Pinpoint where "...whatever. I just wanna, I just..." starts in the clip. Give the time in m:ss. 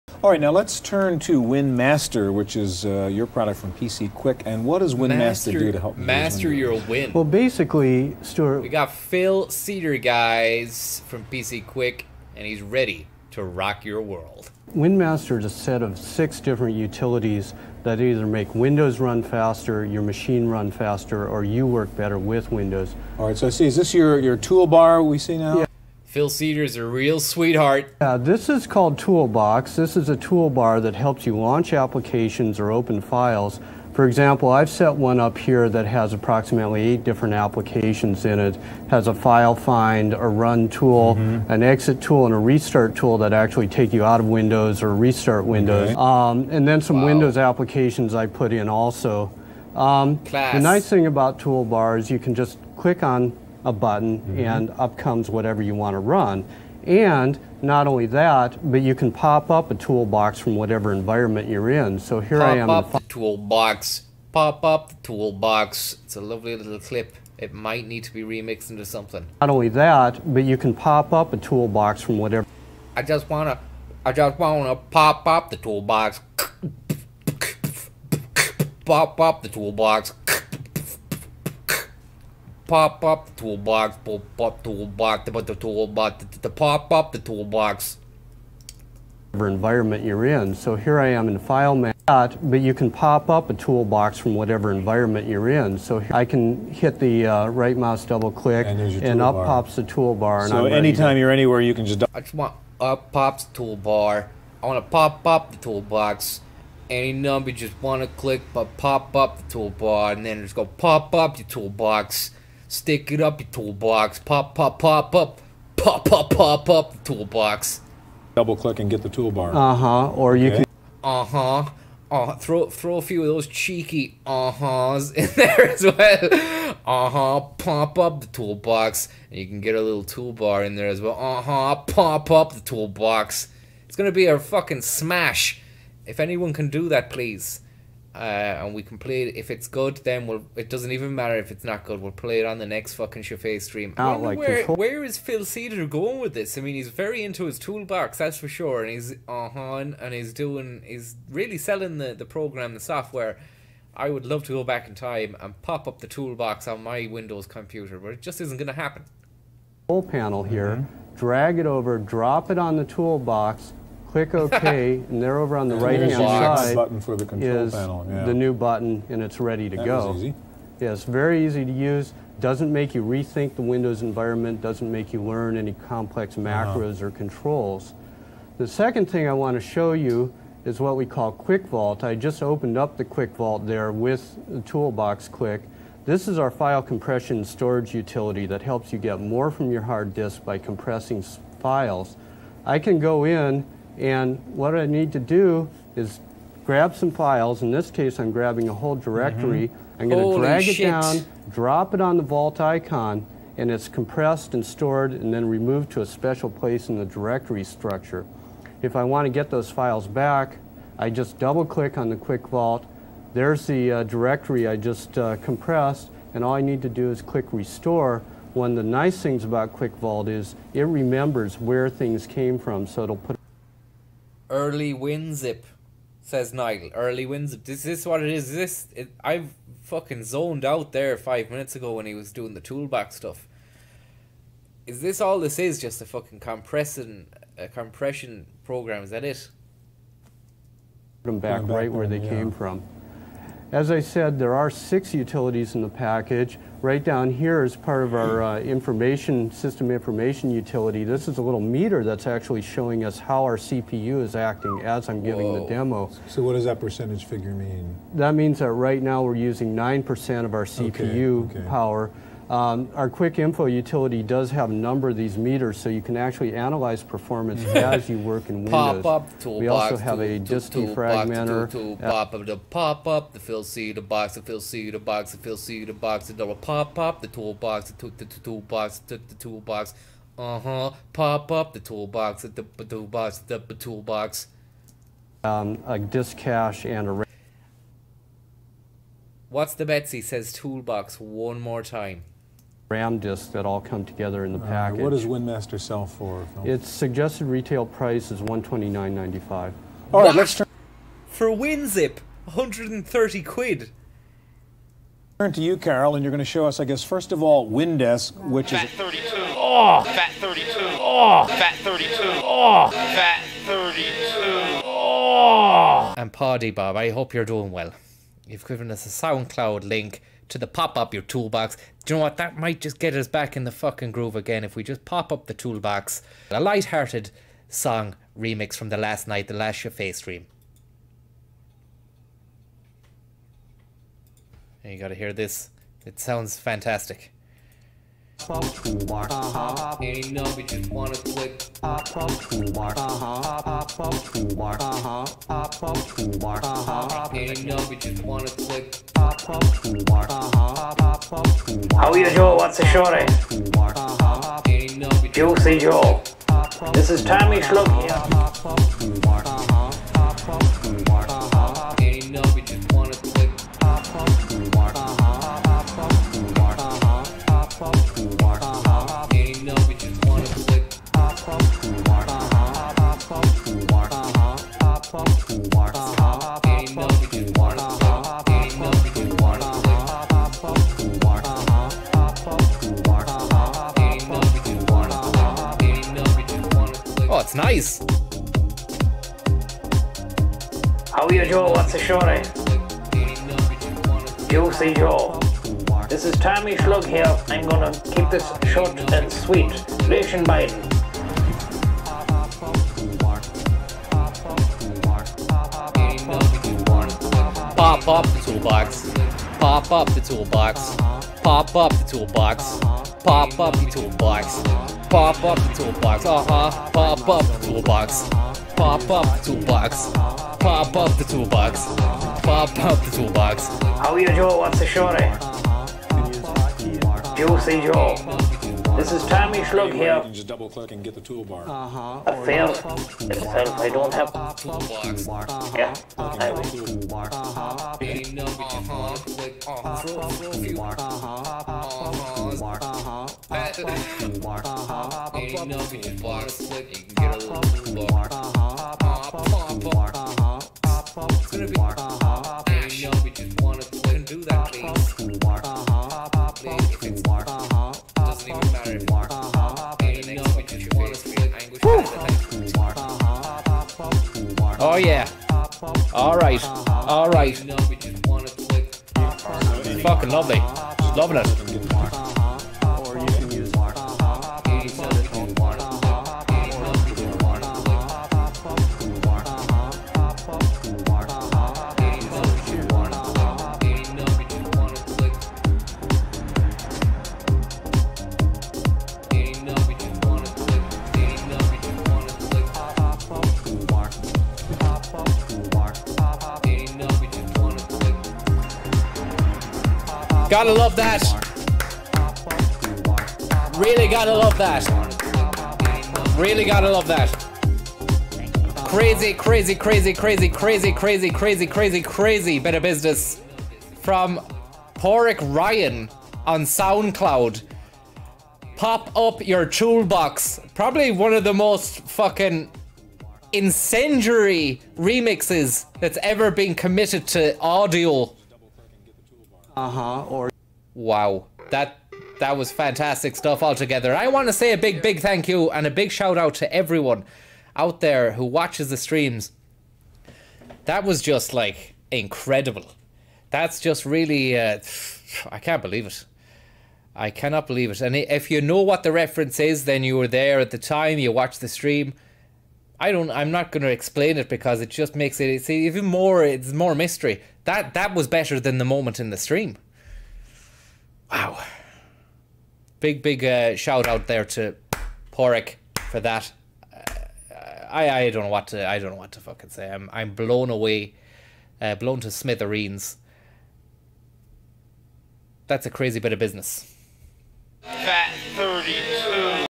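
1:12.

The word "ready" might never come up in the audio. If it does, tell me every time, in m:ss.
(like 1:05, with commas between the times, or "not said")
0:12, 2:49.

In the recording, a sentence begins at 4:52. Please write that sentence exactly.
RAM disks that all come together in the uh, package.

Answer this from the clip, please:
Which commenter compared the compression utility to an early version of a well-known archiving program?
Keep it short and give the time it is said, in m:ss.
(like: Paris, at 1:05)
Nigel, at 3:46.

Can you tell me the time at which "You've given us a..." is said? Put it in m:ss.
5:18.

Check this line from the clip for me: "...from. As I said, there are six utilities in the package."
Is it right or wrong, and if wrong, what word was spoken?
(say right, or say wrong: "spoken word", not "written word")
right.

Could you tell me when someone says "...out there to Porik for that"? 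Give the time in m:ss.
9:24.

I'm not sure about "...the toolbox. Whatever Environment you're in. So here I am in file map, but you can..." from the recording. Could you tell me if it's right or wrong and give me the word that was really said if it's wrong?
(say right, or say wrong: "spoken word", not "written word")
right.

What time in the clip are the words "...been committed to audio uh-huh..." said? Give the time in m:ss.
8:46.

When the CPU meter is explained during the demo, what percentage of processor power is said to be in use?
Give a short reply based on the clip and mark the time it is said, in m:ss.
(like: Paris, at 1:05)
9%, at 4:19.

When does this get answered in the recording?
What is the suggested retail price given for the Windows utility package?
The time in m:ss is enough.
4:58.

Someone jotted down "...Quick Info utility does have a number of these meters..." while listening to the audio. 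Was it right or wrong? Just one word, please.
right.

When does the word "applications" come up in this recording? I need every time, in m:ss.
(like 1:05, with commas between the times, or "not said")
0:31, 0:37, 0:47.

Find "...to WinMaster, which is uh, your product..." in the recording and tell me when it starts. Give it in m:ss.
0:01.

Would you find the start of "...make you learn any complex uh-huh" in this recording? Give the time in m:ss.
2:54.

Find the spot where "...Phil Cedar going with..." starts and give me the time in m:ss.
2:25.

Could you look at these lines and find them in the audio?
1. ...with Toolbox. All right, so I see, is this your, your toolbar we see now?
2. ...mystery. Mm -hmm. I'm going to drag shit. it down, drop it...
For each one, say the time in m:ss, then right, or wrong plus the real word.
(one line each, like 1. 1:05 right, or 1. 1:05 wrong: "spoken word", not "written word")
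1. 0:22 wrong: "Windows", not "Toolbox"
2. 3:18 wrong: "directory", not "mystery".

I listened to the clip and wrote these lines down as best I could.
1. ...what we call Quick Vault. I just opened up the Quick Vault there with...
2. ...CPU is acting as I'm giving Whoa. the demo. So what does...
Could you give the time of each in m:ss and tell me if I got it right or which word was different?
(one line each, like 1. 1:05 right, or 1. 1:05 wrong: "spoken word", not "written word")
1. 3:00 right
2. 4:13 right.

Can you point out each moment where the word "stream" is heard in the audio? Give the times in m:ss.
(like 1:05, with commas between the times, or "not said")
2:23, 5:30, 8:58, 9:11, 9:19.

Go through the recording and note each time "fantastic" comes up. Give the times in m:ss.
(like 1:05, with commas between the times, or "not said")
5:36, 8:52.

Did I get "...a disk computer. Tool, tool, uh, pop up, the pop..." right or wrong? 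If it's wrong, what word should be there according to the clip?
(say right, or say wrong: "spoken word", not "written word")
wrong: "defragmenter", not "computer".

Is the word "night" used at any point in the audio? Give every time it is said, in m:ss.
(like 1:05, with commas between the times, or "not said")
5:29.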